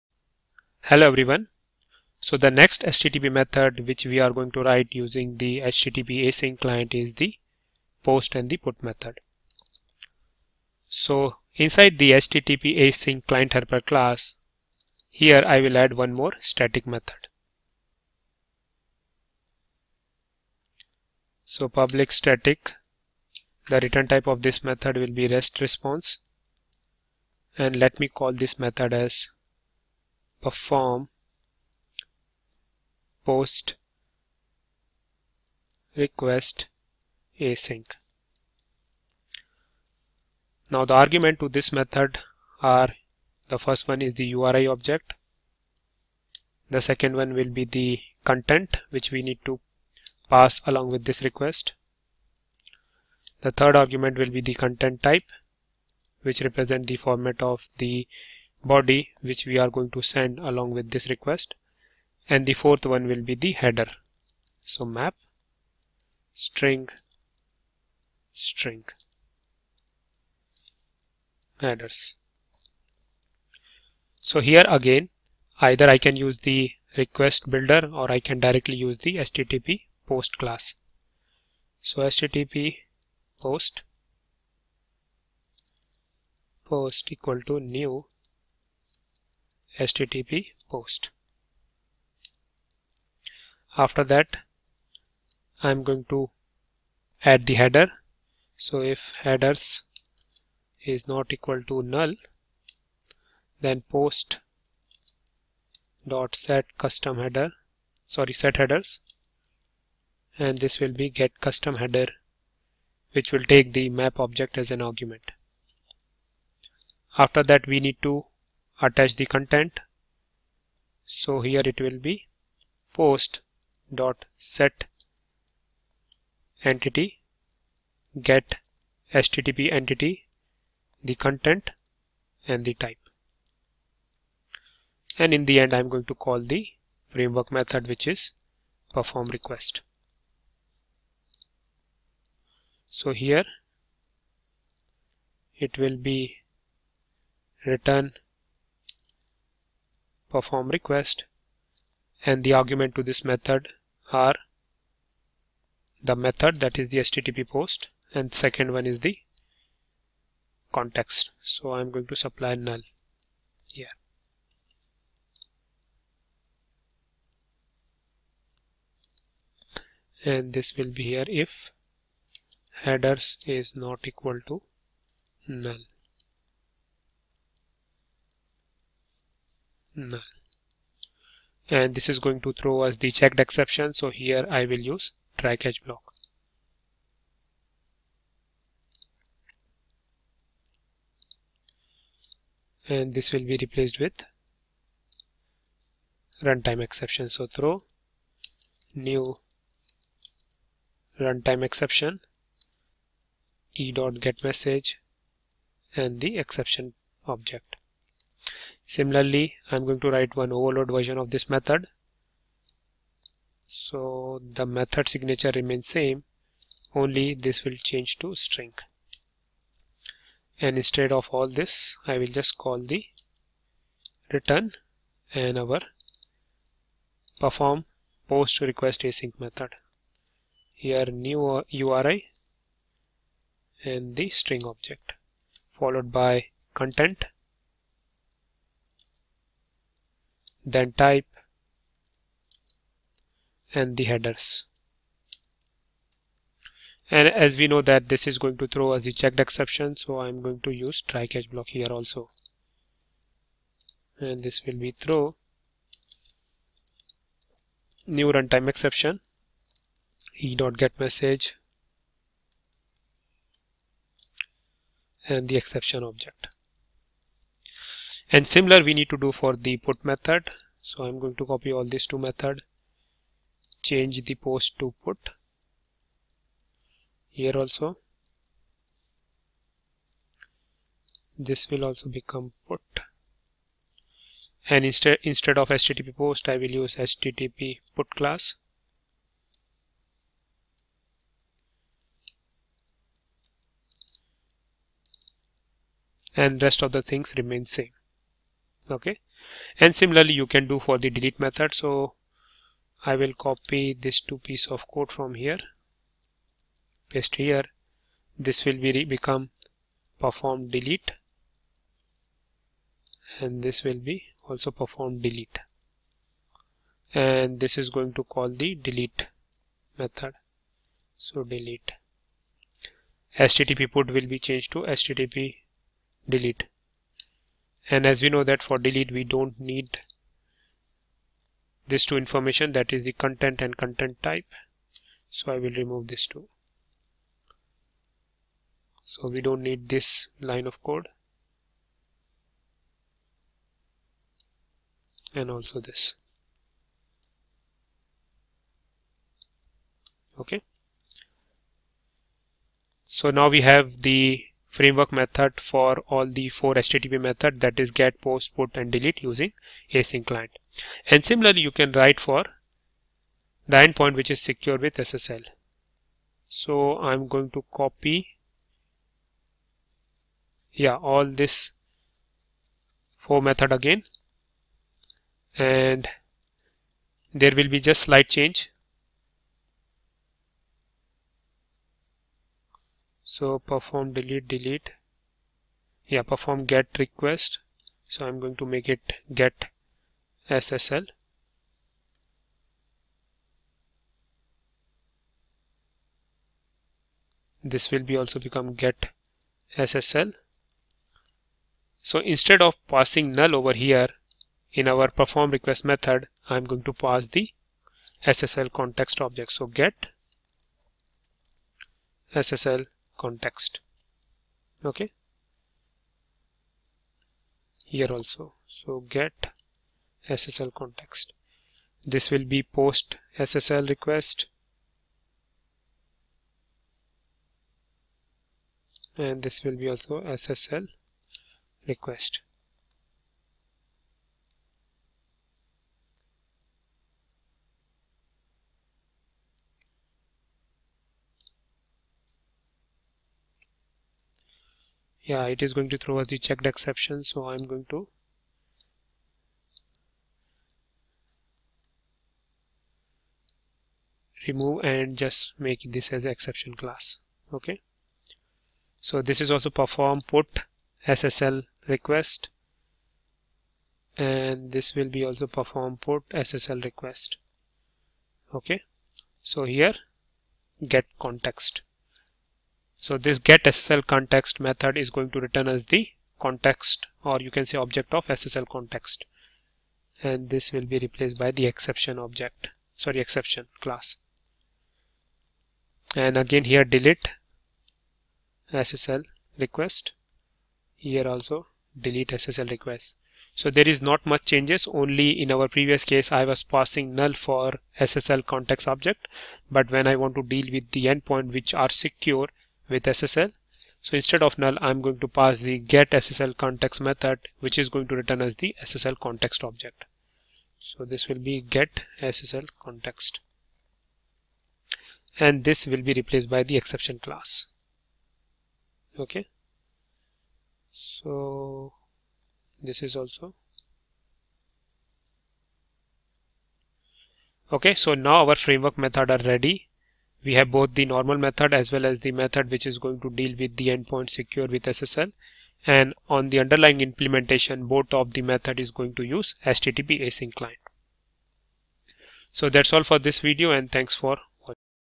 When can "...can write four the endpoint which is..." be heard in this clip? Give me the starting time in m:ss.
6:01.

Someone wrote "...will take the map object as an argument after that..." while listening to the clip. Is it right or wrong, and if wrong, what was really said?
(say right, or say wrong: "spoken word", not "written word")
right.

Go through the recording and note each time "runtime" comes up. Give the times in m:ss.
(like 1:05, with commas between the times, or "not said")
3:16, 3:21, 4:18.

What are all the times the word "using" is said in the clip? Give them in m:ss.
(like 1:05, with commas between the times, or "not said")
0:04, 5:59.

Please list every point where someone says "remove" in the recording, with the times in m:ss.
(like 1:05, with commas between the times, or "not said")
5:35, 7:34.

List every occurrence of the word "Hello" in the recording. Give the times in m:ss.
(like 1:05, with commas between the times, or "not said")
0:00.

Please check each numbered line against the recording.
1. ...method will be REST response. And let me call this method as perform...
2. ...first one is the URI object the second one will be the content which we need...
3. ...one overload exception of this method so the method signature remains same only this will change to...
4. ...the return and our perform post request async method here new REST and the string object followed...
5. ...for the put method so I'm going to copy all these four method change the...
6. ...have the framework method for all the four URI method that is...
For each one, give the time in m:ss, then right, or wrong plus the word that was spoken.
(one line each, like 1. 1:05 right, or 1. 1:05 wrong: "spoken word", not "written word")
1. 0:24 right
2. 0:43 right
3. 3:30 wrong: "version", not "exception"
4. 3:42 wrong: "URI", not "REST"
5. 4:29 wrong: "two", not "four"
6. 5:53 wrong: "HTTP", not "URI".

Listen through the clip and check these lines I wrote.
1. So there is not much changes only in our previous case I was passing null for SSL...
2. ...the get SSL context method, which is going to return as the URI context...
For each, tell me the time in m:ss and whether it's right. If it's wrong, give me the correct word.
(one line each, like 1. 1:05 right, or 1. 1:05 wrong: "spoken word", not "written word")
1. 8:13 right
2. 8:25 wrong: "SSL", not "URI".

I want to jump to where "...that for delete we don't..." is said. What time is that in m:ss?
5:28.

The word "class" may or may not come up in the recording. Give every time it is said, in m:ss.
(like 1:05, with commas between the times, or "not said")
0:13, 1:20, 4:48, 7:36, 8:03, 8:37.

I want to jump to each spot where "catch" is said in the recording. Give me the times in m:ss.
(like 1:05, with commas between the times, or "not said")
3:05, 4:11.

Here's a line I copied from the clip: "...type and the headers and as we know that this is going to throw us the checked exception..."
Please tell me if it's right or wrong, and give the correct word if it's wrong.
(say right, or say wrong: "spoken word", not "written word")
right.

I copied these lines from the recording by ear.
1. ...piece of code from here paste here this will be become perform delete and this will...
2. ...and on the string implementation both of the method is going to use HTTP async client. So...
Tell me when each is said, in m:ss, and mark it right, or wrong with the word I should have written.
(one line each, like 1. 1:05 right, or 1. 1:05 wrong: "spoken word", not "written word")
1. 5:04 right
2. 8:55 wrong: "underlying", not "string".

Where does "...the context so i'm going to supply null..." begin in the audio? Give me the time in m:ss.
2:39.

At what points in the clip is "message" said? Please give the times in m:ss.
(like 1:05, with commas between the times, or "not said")
3:24, 4:20.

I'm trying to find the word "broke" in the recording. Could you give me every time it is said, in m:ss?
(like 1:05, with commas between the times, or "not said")
not said.